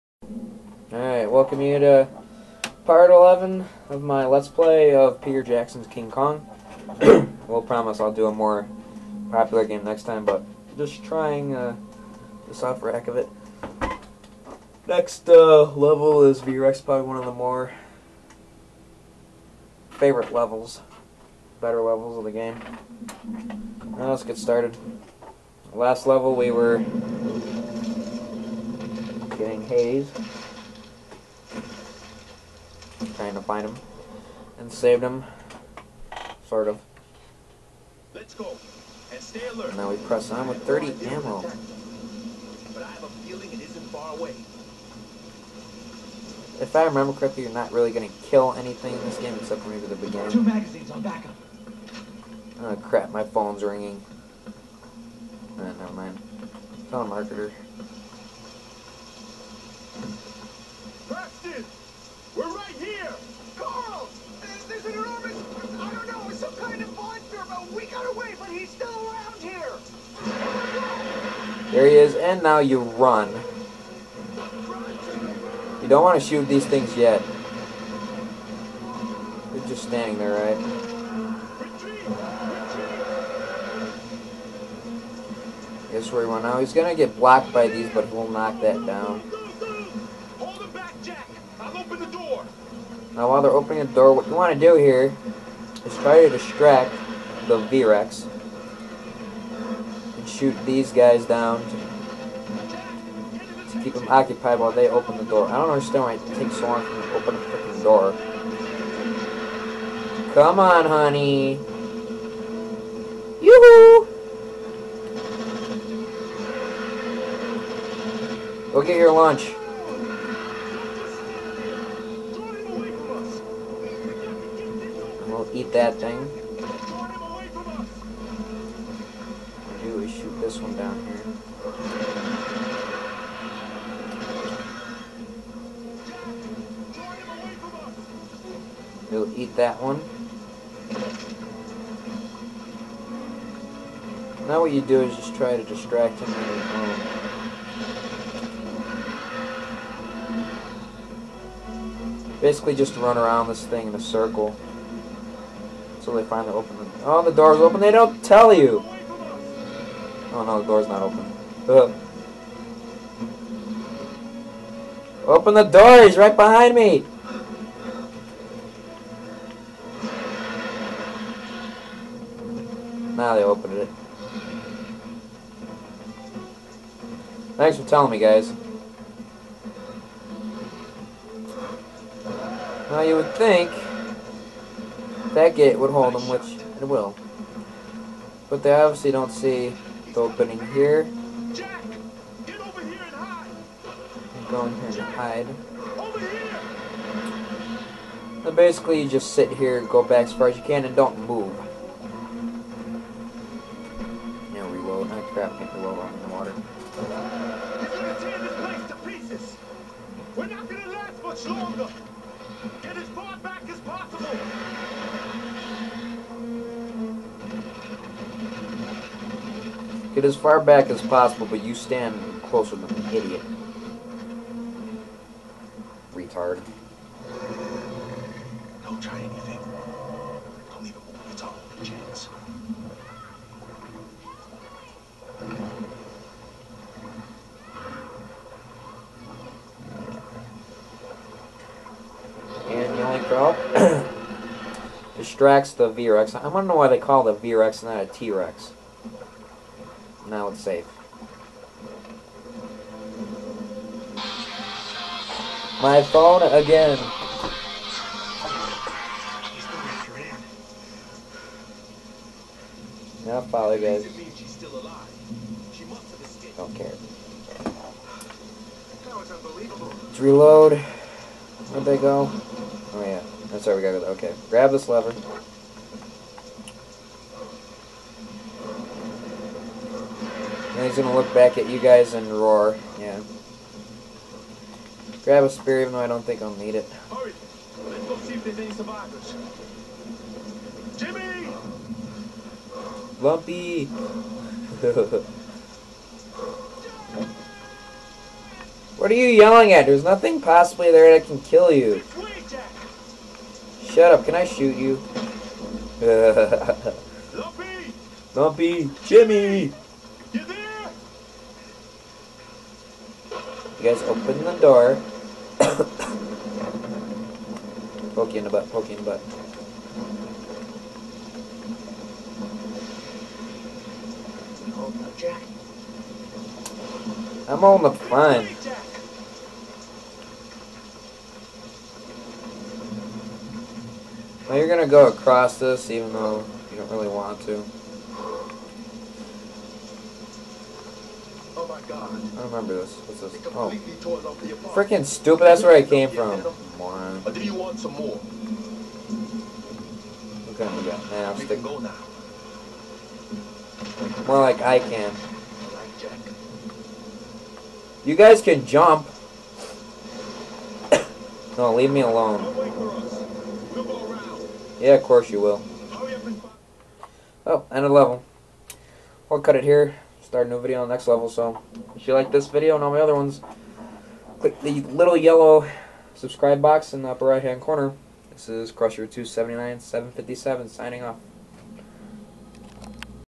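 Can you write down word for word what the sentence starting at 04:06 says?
I want to know why they call it a V-Rex and not a T-Rex.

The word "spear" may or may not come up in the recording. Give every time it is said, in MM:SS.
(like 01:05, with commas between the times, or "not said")
04:45.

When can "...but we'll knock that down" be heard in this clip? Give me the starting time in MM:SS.
01:27.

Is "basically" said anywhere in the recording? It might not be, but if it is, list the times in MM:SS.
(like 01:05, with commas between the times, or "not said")
02:32, 03:18.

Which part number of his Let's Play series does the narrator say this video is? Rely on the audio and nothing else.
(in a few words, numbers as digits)
11.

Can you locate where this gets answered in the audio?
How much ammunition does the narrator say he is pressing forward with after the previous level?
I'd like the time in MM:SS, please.
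00:40.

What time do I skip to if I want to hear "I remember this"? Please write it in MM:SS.
05:42.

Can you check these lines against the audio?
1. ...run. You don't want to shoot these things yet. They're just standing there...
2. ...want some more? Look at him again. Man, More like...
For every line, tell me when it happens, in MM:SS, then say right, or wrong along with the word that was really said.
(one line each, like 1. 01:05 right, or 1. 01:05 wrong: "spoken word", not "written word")
1. 01:12 right
2. 05:47 right.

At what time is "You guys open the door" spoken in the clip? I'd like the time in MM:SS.
05:13.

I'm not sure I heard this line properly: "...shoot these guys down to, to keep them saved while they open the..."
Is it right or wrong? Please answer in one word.
wrong.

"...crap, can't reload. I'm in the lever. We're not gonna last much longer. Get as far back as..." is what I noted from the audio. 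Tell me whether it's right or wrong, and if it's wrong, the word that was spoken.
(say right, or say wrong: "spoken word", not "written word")
wrong: "water", not "lever".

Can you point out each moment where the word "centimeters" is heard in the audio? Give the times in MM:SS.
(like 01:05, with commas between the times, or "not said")
not said.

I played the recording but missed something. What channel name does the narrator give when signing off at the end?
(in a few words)
Crusher279-757.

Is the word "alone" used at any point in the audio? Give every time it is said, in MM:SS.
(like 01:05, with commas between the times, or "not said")
06:02.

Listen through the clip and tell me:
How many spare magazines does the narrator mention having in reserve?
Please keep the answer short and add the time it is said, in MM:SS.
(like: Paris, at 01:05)
2, at 00:50.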